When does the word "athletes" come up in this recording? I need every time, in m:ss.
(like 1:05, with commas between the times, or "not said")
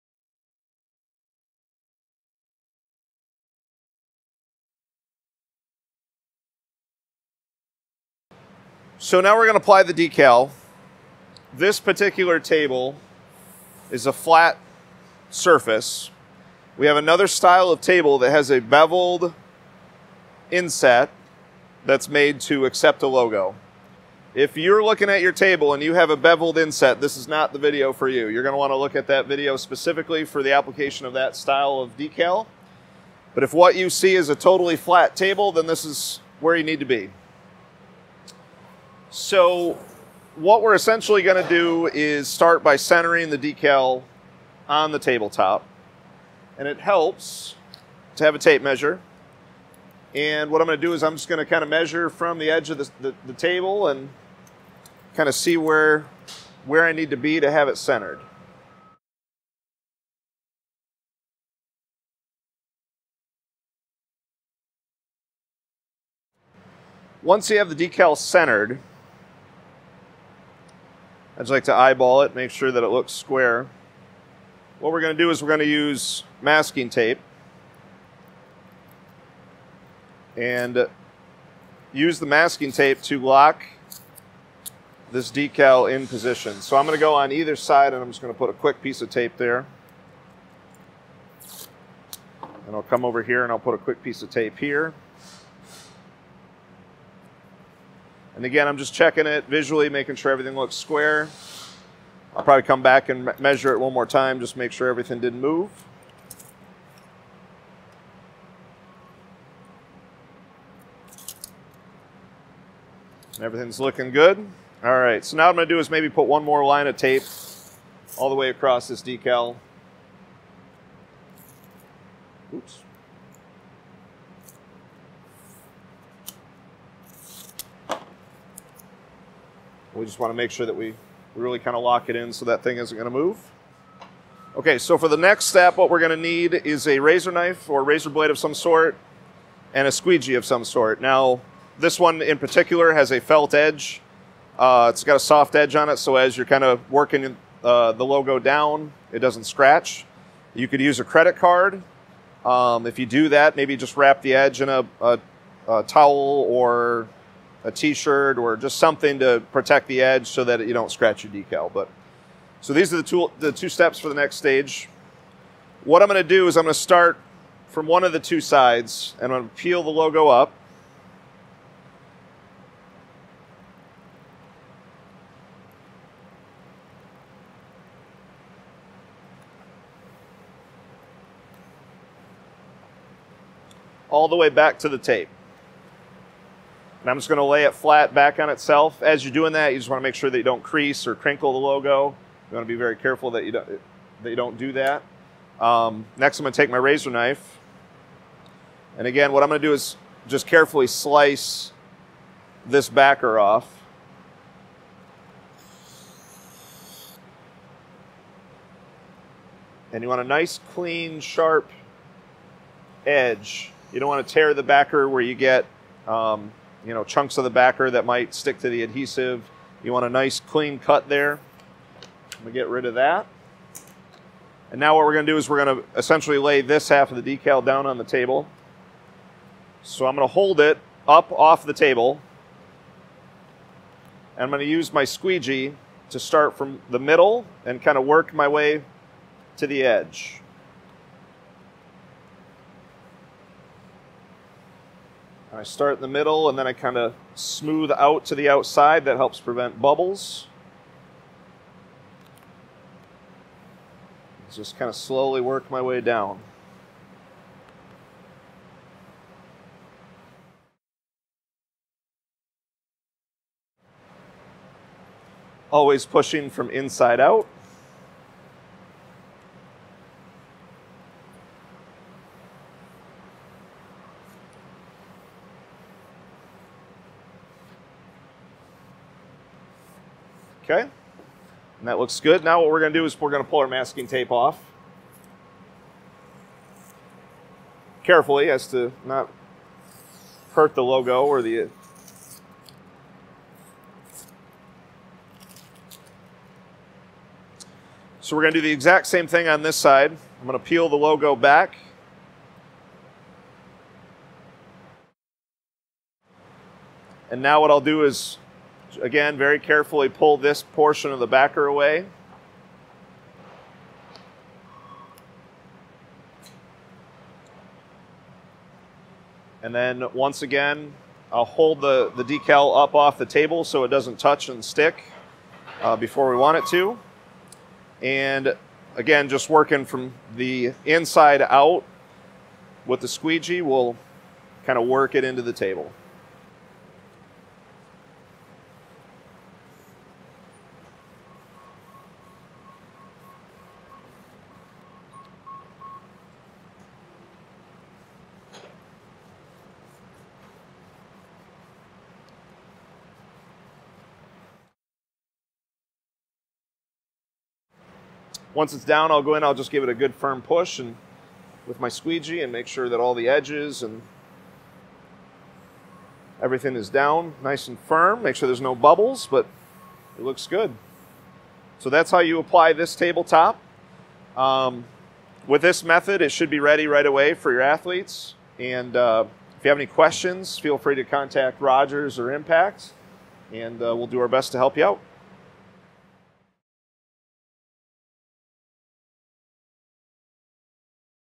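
6:17.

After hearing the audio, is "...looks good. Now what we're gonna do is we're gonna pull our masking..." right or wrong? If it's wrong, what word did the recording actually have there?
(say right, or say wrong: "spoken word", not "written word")
right.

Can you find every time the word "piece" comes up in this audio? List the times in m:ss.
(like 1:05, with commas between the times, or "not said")
1:28, 1:34.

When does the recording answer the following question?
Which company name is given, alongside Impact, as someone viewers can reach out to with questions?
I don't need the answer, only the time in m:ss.
6:21.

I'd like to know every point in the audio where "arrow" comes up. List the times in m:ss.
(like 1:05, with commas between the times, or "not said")
not said.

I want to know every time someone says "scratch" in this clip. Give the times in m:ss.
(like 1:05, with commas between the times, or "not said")
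2:29, 2:40.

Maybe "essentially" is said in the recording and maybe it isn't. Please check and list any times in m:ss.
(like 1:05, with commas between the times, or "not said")
0:40, 3:45.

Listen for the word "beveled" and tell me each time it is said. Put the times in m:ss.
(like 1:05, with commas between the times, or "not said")
0:18, 0:26.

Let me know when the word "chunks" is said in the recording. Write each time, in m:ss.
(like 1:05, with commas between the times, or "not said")
3:37.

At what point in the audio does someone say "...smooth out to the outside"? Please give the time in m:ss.
4:07.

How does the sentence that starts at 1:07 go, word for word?
Once you have the decal centered, I just like to eyeball it, make sure that it looks square.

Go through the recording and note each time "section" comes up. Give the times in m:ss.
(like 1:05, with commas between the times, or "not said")
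not said.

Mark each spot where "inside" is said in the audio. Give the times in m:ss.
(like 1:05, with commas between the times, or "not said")
4:26, 5:30.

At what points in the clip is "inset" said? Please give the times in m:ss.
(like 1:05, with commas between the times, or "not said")
0:20, 0:26.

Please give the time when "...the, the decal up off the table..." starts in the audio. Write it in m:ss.
5:21.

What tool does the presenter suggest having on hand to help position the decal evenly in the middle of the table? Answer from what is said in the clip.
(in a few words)
Tape measure.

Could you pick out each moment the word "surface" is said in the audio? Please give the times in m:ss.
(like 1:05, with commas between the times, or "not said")
0:15.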